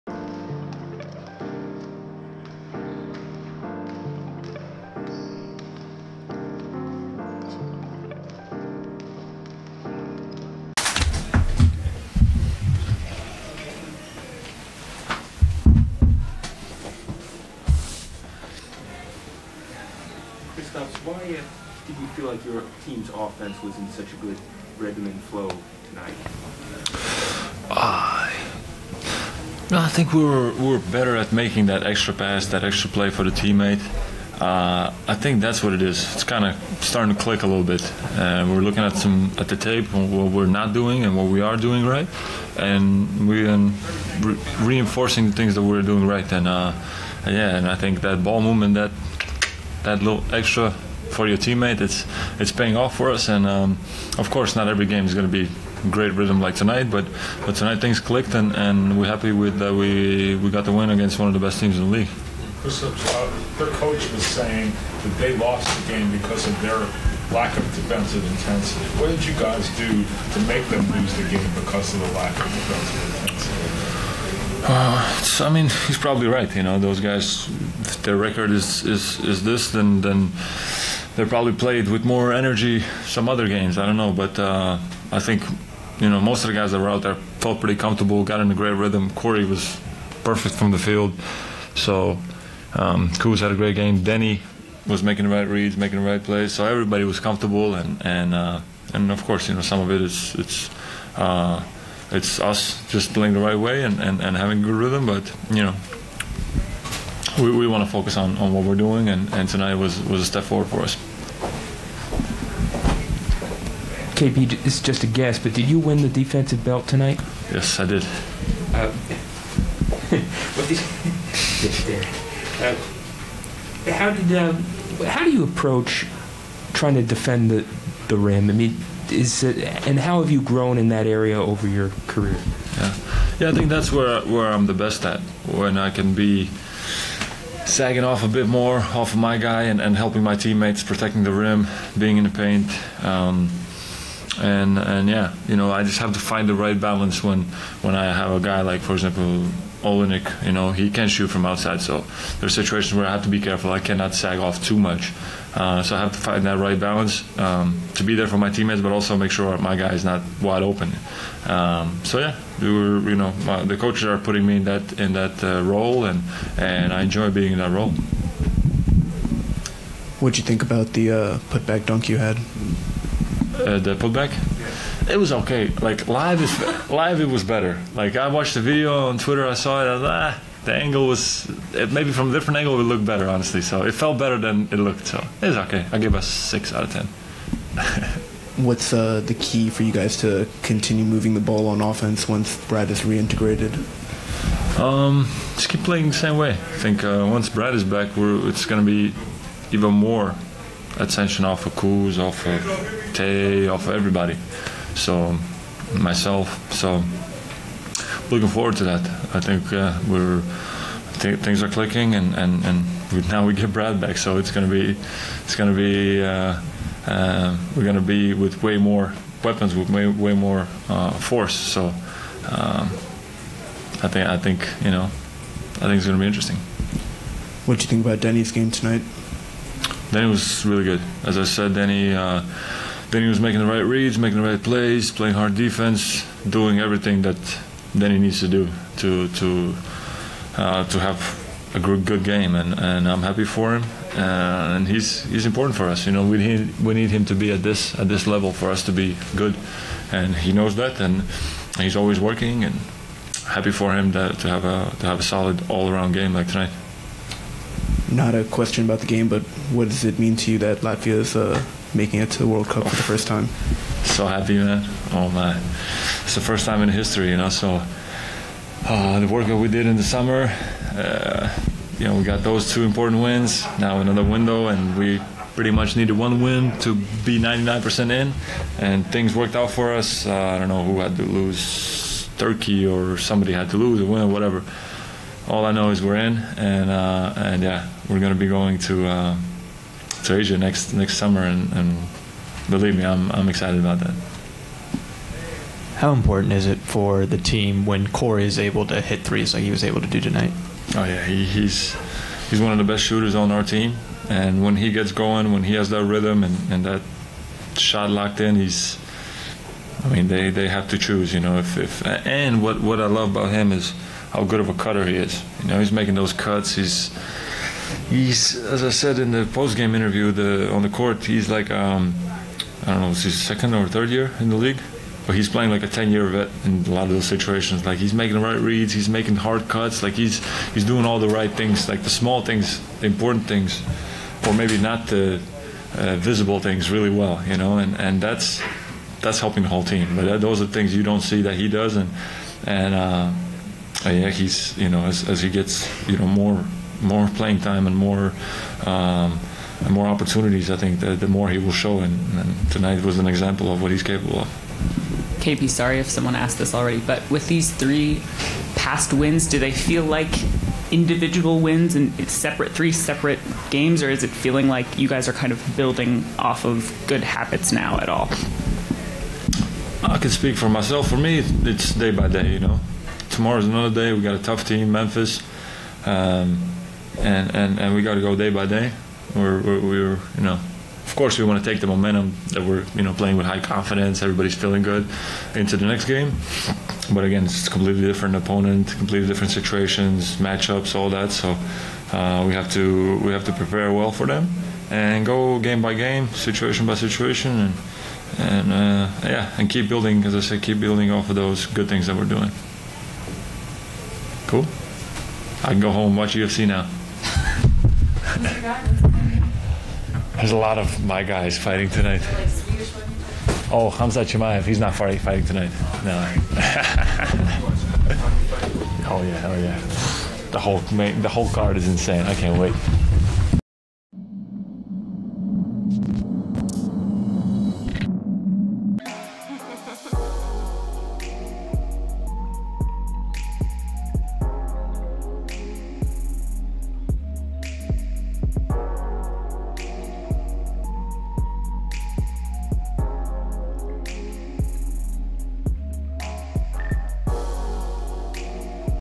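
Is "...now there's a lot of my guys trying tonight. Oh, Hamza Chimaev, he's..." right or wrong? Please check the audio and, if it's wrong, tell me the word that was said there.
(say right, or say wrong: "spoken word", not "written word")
wrong: "fighting", not "trying".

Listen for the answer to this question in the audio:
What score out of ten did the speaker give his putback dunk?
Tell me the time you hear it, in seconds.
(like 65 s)
186 s.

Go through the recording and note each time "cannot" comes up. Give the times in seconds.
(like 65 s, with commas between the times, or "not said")
153 s.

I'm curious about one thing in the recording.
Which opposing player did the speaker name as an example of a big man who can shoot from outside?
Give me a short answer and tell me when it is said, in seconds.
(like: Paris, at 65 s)
Olynyk, at 149 s.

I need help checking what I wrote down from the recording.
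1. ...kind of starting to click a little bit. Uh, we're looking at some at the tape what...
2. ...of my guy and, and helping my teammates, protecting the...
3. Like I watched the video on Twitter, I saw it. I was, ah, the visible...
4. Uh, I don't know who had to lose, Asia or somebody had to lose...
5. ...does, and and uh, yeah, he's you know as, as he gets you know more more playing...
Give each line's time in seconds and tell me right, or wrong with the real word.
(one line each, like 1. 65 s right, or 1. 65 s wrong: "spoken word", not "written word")
1. 36 s right
2. 139 s right
3. 177 s wrong: "angle", not "visible"
4. 280 s wrong: "Turkey", not "Asia"
5. 341 s right.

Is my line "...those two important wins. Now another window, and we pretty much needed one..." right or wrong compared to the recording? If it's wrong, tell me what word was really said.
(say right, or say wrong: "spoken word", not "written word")
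right.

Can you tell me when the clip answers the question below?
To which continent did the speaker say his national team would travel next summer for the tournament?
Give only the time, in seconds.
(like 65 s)
290 s.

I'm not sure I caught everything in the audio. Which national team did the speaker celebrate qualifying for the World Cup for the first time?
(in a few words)
Latvia.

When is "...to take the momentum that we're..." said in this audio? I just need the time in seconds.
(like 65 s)
381 s.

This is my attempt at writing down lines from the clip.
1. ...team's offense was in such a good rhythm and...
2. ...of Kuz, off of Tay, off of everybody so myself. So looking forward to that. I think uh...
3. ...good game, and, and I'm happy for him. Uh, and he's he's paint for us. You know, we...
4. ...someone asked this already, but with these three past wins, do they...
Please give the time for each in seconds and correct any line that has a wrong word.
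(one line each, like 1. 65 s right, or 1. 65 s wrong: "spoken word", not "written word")
1. 22 s right
2. 201 s right
3. 242 s wrong: "important", not "paint"
4. 356 s right.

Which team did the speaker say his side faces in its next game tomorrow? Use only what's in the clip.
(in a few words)
Memphis.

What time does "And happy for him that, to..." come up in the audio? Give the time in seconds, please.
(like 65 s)
252 s.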